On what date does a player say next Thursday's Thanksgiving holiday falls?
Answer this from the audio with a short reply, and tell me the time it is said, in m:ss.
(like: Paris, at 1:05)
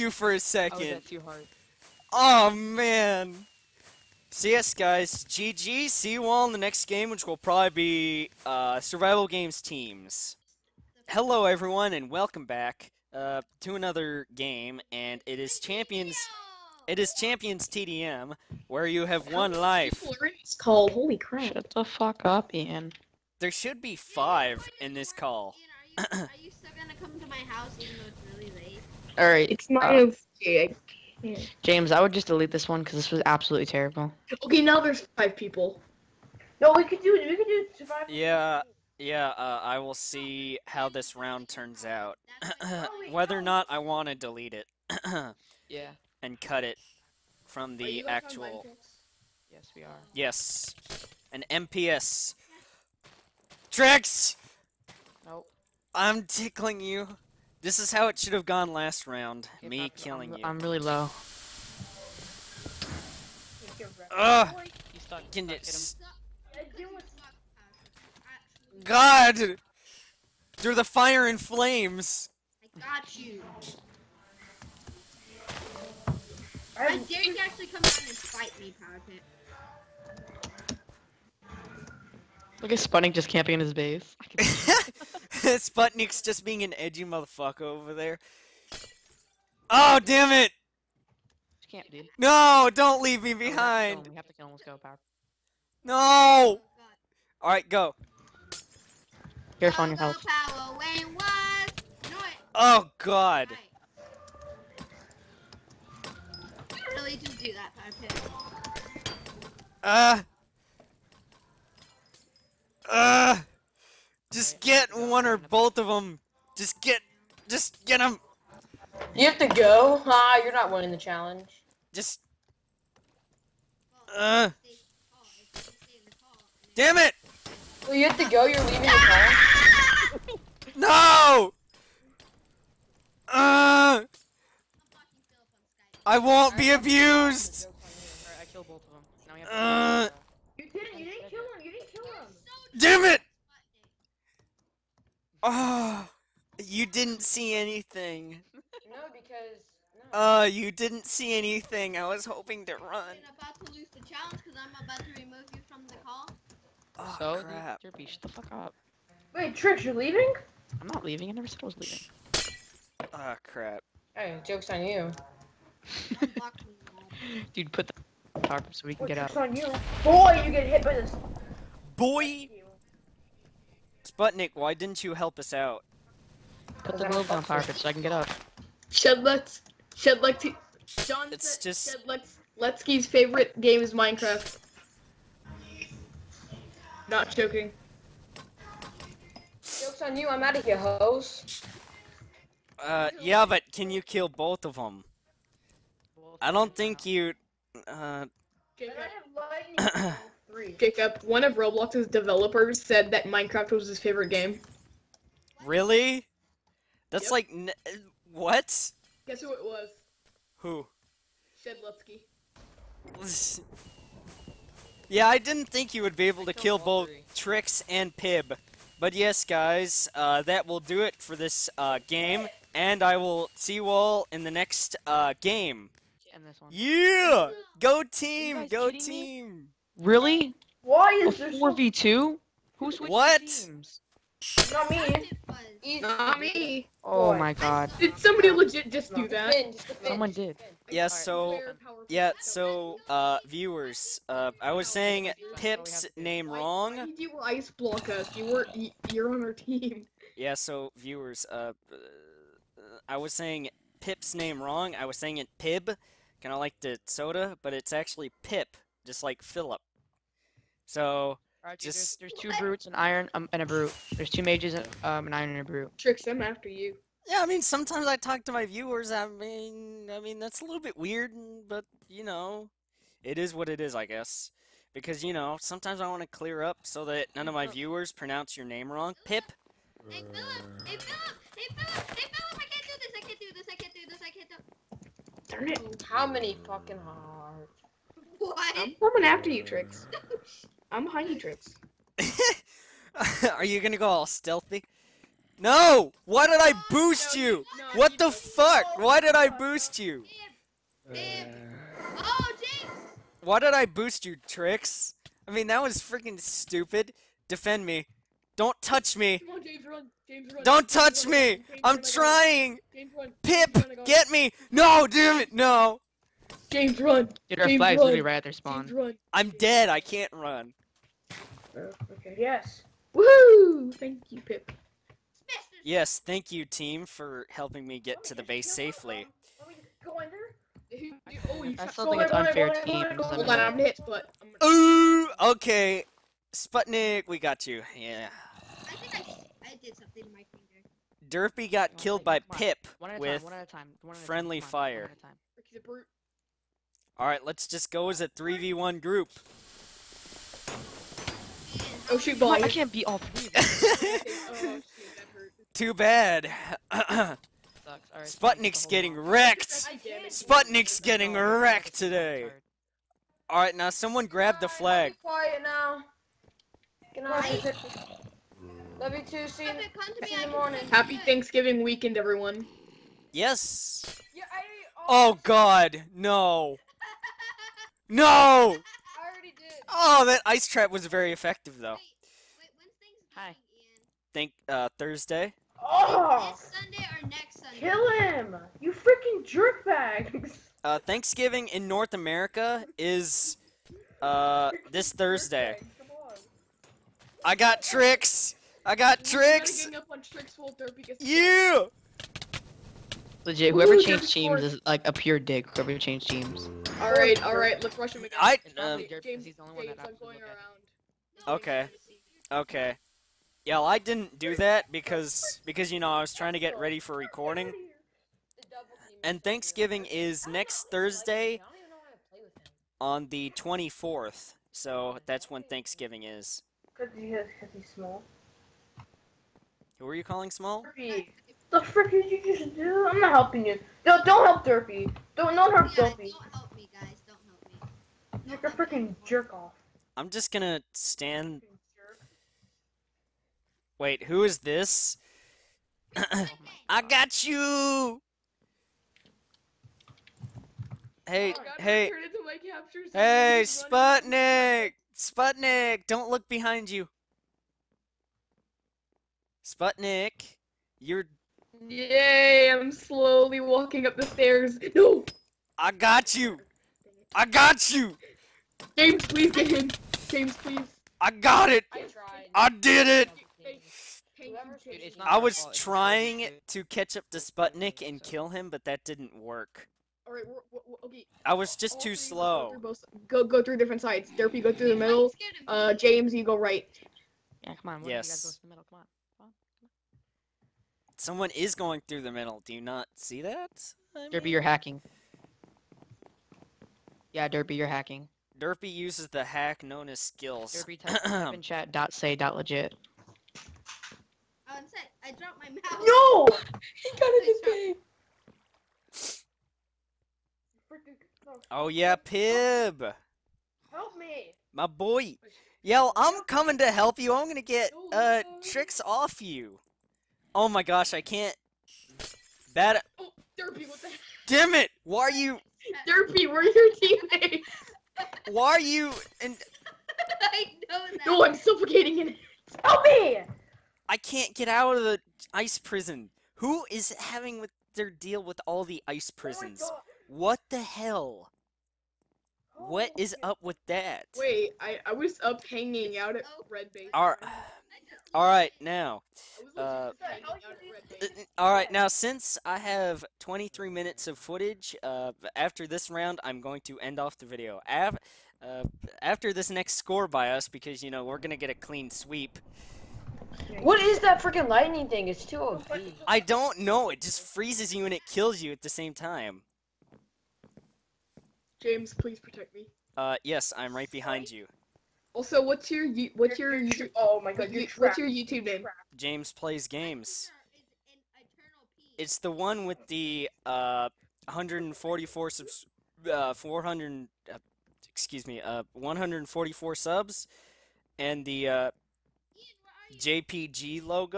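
24th, at 7:03.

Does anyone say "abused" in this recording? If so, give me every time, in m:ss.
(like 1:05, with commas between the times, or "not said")
2:16.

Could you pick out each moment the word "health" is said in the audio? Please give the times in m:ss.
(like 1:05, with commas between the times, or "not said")
1:39.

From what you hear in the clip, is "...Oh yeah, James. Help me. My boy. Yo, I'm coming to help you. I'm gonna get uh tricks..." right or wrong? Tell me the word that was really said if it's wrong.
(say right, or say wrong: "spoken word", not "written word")
wrong: "Pib", not "James".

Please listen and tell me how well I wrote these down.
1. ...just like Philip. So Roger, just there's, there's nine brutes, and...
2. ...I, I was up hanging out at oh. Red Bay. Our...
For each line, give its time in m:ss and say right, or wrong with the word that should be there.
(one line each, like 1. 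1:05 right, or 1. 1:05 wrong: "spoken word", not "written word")
1. 4:19 wrong: "two", not "nine"
2. 9:04 right.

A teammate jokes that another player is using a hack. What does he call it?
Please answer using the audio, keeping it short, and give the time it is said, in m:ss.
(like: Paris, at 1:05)
skills, at 8:20.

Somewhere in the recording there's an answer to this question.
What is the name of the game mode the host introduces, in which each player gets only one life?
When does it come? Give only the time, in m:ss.
0:17.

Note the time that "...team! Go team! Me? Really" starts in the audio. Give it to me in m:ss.
3:48.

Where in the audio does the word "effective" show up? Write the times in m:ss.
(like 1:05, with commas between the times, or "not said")
6:21.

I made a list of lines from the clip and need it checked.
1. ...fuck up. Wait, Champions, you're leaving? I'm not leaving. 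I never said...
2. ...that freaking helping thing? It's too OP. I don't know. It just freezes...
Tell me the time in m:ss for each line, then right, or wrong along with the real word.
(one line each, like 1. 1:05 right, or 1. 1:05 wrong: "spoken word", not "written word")
1. 2:38 wrong: "Trish", not "Champions"
2. 9:24 wrong: "lightning", not "helping".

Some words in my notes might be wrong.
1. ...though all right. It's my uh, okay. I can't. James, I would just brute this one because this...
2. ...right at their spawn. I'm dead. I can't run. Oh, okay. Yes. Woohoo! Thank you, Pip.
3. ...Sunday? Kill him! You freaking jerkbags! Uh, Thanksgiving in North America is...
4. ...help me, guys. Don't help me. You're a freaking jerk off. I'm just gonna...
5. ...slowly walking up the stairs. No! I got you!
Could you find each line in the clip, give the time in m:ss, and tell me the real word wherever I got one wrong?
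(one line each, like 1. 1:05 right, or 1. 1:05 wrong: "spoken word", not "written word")
1. 0:27 wrong: "delete", not "brute"
2. 5:18 right
3. 6:27 right
4. 7:16 right
5. 7:42 right.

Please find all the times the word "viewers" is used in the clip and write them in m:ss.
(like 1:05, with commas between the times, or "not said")
4:03, 4:10, 4:28, 4:37.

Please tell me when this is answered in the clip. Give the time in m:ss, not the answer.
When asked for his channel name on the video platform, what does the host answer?
9:39.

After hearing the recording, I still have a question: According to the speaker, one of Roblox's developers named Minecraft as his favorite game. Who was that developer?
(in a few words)
Shedlupski.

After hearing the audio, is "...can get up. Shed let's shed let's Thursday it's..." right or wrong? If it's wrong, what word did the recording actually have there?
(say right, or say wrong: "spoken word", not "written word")
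wrong: "John", not "Thursday".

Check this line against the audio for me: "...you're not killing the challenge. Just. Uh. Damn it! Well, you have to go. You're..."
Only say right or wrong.
wrong.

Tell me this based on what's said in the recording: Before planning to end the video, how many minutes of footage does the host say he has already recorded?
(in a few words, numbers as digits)
23 minutes.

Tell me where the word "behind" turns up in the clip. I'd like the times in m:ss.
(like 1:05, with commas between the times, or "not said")
1:33, 7:36, 9:34.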